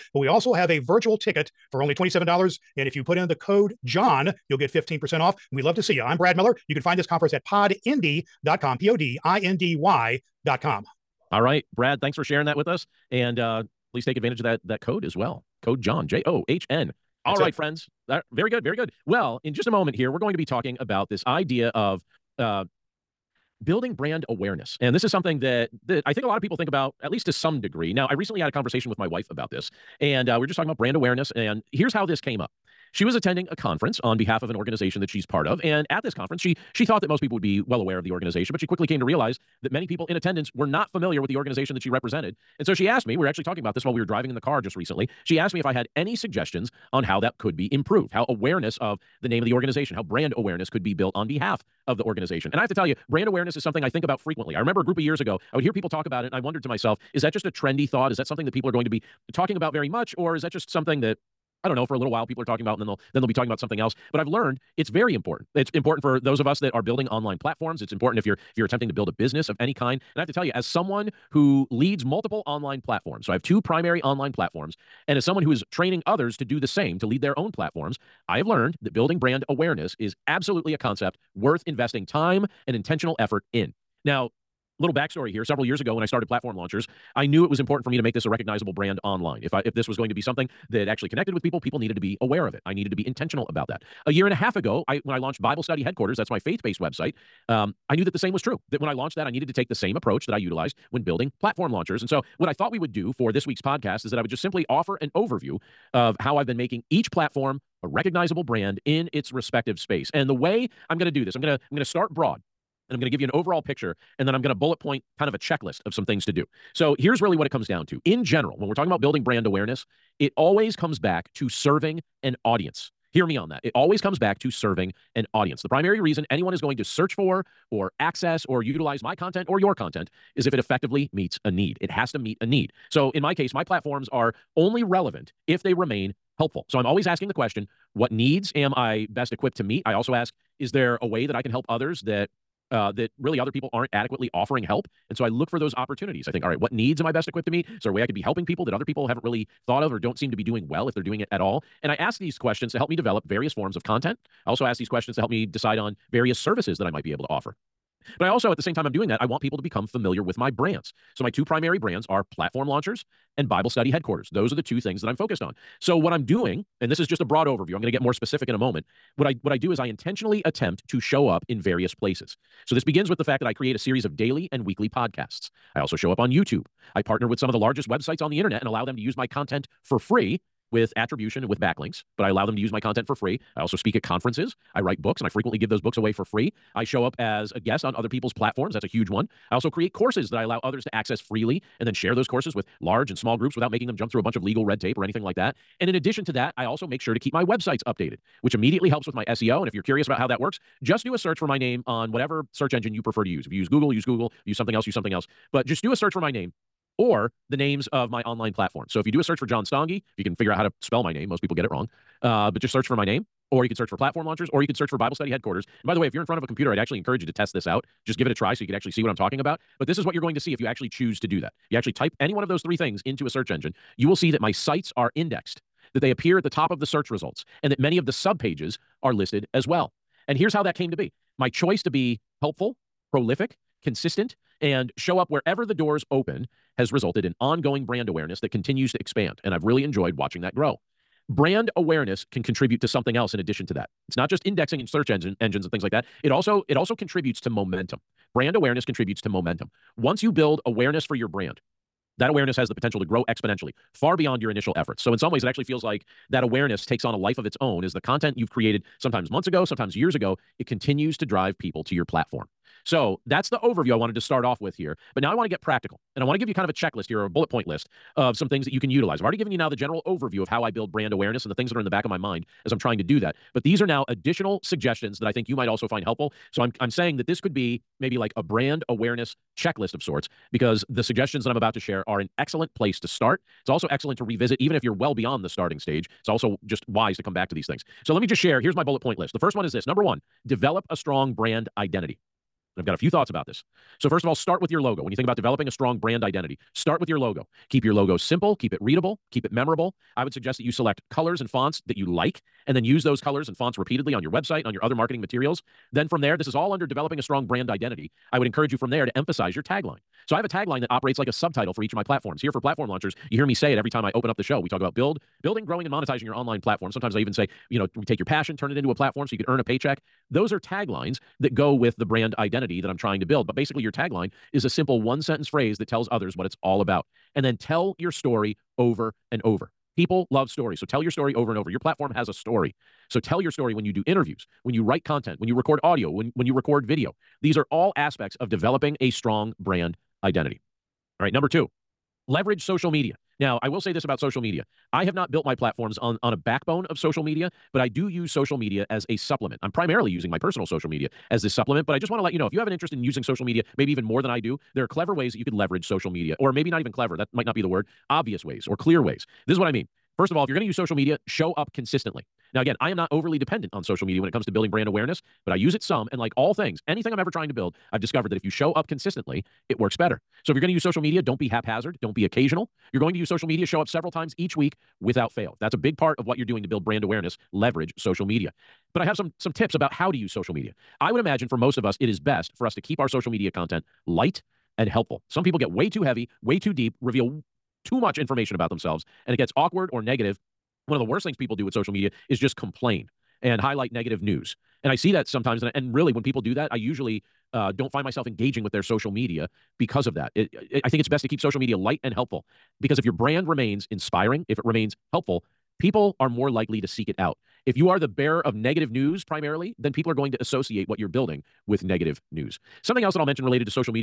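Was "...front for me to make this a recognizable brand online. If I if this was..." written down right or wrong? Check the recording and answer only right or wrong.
wrong.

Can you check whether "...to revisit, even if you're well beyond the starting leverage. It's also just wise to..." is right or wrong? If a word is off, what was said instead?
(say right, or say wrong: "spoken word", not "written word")
wrong: "stage", not "leverage".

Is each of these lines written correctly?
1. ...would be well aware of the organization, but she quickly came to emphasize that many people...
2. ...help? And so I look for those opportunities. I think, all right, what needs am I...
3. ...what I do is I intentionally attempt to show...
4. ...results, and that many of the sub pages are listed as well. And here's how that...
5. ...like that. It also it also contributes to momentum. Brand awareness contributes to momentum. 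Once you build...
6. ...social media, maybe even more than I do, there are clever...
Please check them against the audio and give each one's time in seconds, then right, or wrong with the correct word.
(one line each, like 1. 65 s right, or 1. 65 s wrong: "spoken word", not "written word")
1. 37 s wrong: "realize", not "emphasize"
2. 144 s right
3. 169 s right
4. 227 s right
5. 245 s right
6. 353 s right.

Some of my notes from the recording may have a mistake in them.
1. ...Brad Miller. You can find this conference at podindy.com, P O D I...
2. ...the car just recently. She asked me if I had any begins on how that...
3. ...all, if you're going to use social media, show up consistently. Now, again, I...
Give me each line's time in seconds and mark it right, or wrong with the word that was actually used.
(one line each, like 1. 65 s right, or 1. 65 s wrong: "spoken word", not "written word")
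1. 6 s right
2. 44 s wrong: "suggestions", not "begins"
3. 360 s right.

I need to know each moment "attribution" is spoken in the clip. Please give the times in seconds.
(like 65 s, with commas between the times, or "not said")
180 s.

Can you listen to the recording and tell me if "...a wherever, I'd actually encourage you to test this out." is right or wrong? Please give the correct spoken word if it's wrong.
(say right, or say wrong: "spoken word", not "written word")
wrong: "computer", not "wherever".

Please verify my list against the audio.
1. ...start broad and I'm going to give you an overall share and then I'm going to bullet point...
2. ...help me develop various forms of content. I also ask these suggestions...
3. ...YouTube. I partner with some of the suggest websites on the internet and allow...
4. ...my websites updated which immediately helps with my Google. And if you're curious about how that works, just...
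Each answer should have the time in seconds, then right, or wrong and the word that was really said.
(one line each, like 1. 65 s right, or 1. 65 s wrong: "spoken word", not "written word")
1. 111 s wrong: "picture", not "share"
2. 152 s wrong: "questions", not "suggestions"
3. 176 s wrong: "largest", not "suggest"
4. 197 s wrong: "SEO", not "Google".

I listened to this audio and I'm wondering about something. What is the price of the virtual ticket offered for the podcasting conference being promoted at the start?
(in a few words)
$27.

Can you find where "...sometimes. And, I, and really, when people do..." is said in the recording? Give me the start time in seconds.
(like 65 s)
395 s.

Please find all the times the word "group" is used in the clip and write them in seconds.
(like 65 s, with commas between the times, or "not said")
54 s, 193 s.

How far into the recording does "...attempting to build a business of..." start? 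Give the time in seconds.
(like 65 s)
68 s.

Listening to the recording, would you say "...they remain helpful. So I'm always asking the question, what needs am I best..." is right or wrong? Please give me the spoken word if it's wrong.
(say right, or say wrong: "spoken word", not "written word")
right.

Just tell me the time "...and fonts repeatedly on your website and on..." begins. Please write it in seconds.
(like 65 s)
303 s.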